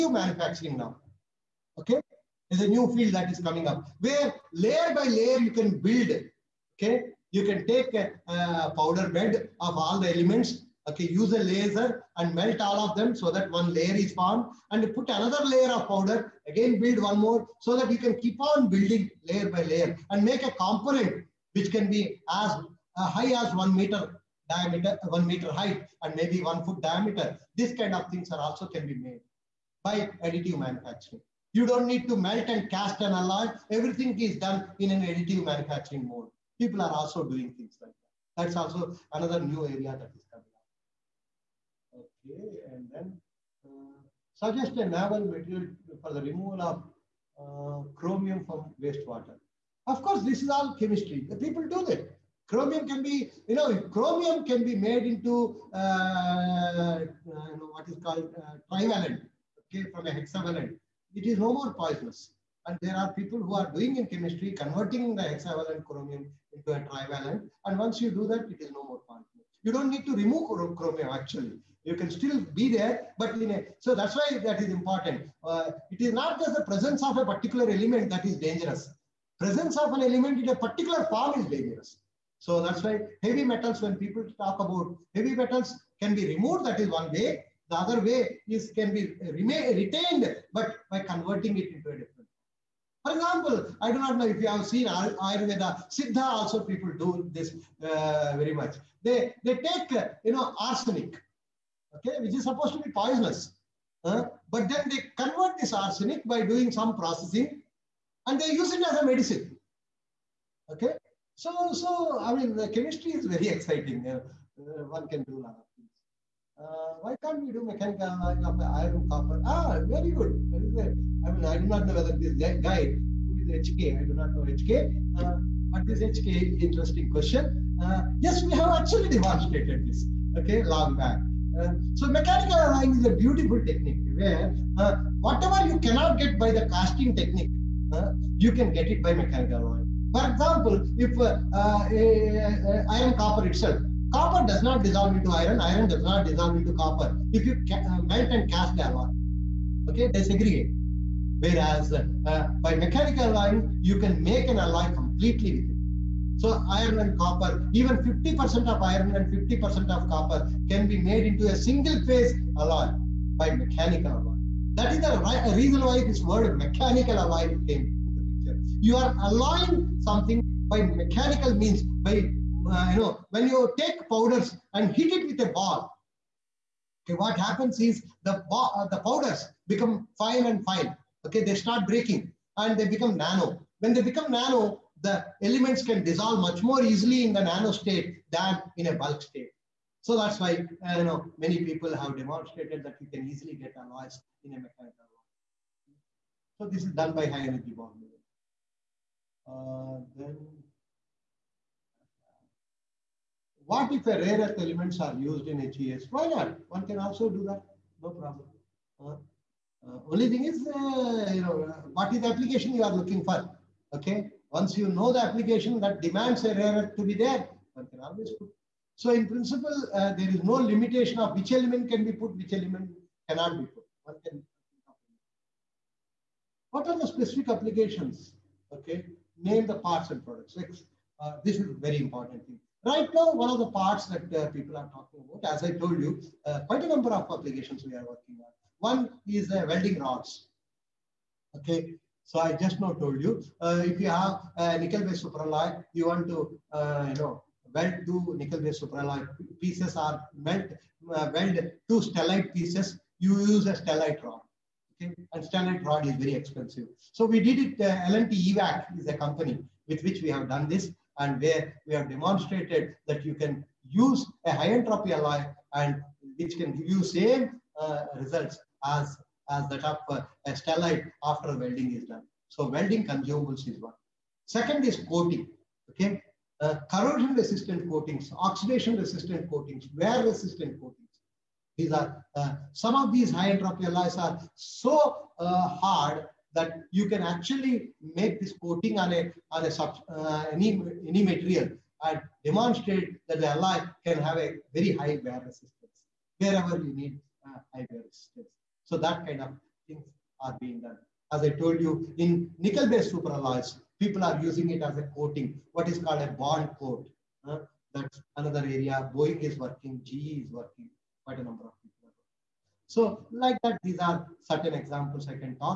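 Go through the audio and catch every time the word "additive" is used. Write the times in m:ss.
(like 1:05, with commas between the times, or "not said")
0:30, 0:35.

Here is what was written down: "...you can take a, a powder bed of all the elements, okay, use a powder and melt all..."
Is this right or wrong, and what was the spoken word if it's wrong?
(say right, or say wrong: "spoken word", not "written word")
wrong: "laser", not "powder".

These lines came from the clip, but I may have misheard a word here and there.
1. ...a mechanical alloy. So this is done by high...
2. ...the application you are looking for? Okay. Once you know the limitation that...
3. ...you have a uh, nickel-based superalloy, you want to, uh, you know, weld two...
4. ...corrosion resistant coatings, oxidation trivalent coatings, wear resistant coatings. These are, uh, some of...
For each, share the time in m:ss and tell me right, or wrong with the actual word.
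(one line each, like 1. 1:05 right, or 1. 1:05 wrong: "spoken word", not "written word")
1. 3:14 right
2. 3:32 wrong: "application", not "limitation"
3. 4:04 right
4. 4:36 wrong: "resistant", not "trivalent".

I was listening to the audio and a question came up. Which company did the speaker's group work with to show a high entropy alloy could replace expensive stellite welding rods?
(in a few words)
L&T EWAC.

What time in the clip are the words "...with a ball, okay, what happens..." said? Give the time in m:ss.
2:55.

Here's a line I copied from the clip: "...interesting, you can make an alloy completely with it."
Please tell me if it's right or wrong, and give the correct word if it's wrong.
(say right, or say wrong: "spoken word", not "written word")
wrong: "alloying", not "interesting".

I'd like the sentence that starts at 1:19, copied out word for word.
Presence of an element in a particular form is dangerous.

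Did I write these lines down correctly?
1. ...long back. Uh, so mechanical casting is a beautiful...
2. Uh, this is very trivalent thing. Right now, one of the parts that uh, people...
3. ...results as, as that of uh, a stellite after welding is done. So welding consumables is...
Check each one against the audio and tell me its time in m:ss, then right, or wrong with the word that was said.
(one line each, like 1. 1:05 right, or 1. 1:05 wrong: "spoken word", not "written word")
1. 2:10 wrong: "alloying", not "casting"
2. 3:51 wrong: "important", not "trivalent"
3. 4:28 right.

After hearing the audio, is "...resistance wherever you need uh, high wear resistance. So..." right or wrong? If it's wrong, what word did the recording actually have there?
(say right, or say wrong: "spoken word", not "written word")
right.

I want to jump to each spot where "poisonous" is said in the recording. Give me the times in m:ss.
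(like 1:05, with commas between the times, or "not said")
1:01, 1:42.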